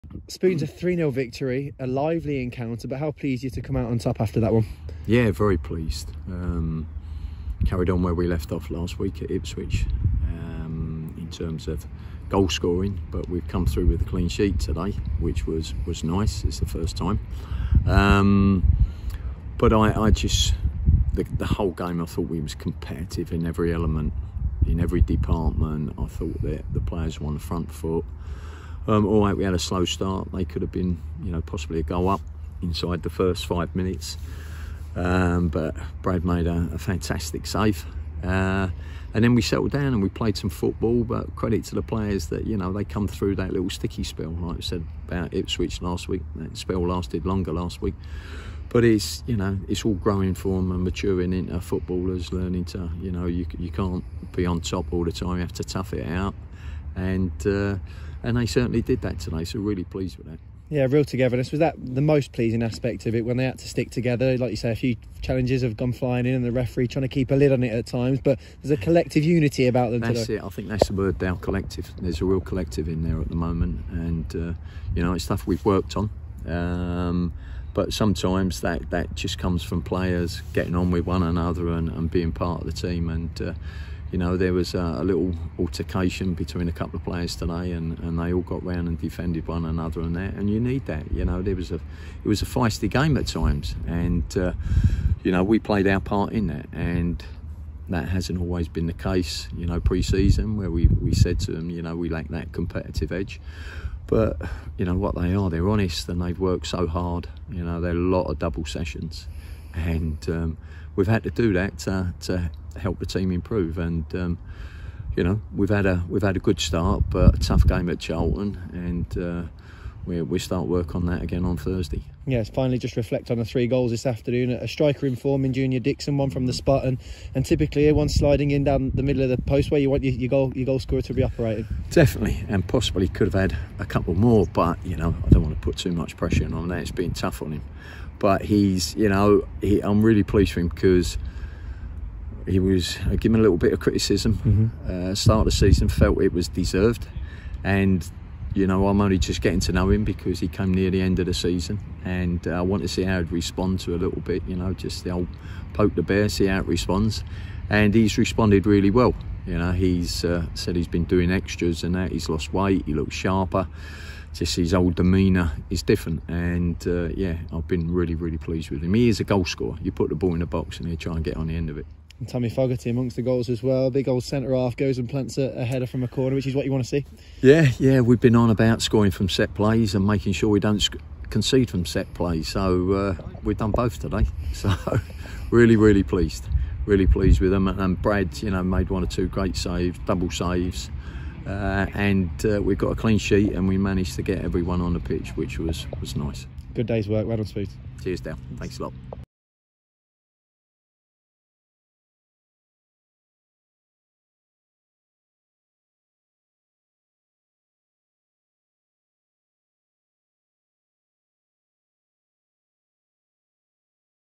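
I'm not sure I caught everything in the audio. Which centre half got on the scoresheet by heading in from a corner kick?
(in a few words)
Tommy Fogarty.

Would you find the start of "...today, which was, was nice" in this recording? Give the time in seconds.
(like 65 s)
14 s.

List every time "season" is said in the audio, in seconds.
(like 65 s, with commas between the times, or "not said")
99 s, 145 s, 151 s.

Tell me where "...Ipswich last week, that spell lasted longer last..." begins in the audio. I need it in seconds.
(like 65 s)
45 s.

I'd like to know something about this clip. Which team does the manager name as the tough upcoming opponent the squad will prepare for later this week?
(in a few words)
Charlton.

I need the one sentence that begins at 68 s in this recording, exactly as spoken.
But there's a collective unity about them.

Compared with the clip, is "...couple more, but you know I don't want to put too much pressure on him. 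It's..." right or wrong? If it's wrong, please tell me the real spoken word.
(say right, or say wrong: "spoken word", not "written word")
right.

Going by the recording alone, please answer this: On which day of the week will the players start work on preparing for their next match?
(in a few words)
Thursday.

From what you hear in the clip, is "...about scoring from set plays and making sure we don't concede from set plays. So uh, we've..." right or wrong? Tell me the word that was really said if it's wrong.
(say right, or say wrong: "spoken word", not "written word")
right.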